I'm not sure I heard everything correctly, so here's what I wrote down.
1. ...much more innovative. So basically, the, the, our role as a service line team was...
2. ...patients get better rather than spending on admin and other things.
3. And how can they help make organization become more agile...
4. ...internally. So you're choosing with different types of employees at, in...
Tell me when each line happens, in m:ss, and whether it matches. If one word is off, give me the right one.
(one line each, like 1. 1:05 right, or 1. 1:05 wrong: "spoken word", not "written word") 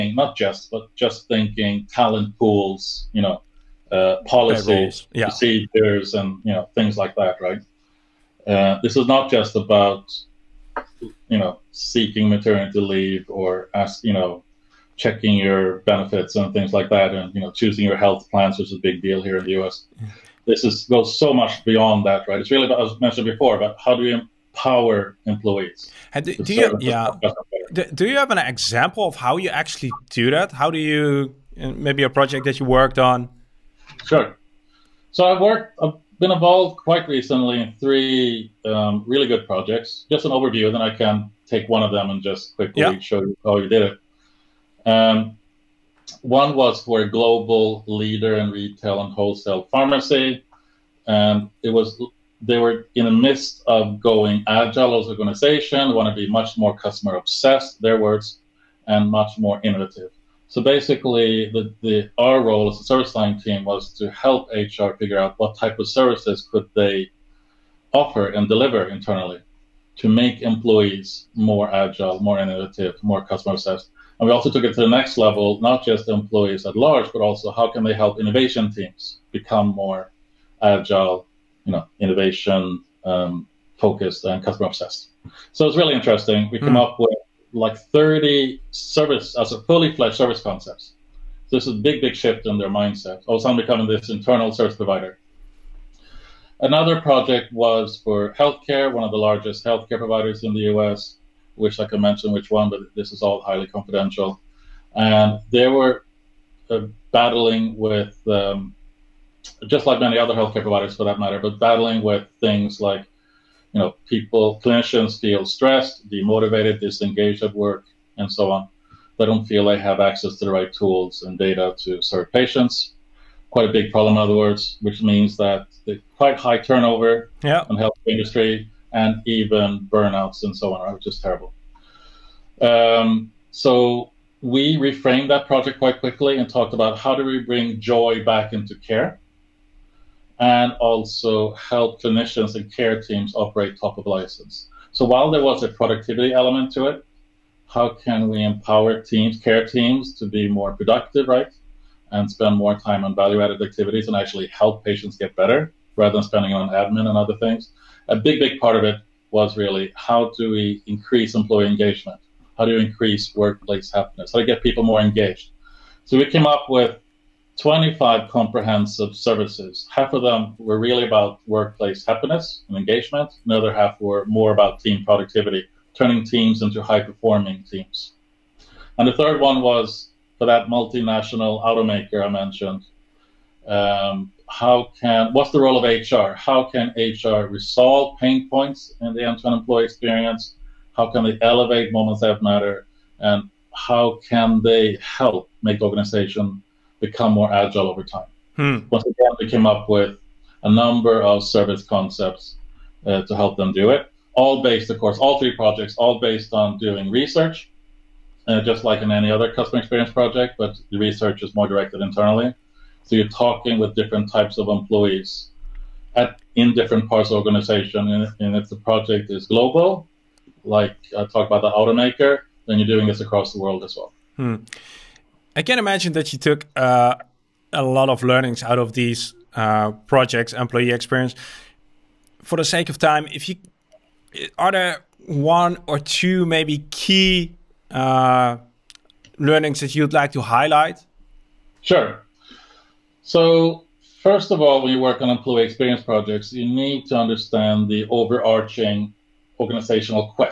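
1. 0:59 right
2. 2:34 right
3. 3:13 right
4. 3:32 wrong: "talking", not "choosing".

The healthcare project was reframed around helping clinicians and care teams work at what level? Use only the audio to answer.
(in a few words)
Top of license.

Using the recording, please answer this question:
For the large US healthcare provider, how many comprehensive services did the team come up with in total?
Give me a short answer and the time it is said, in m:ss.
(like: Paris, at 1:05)
25, at 2:47.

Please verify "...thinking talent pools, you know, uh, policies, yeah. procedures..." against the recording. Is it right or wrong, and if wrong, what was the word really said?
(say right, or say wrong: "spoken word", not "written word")
right.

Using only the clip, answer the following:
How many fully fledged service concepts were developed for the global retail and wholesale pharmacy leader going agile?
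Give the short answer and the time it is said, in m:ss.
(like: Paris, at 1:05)
30, at 1:27.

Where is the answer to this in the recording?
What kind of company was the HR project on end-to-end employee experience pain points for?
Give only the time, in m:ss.
3:00.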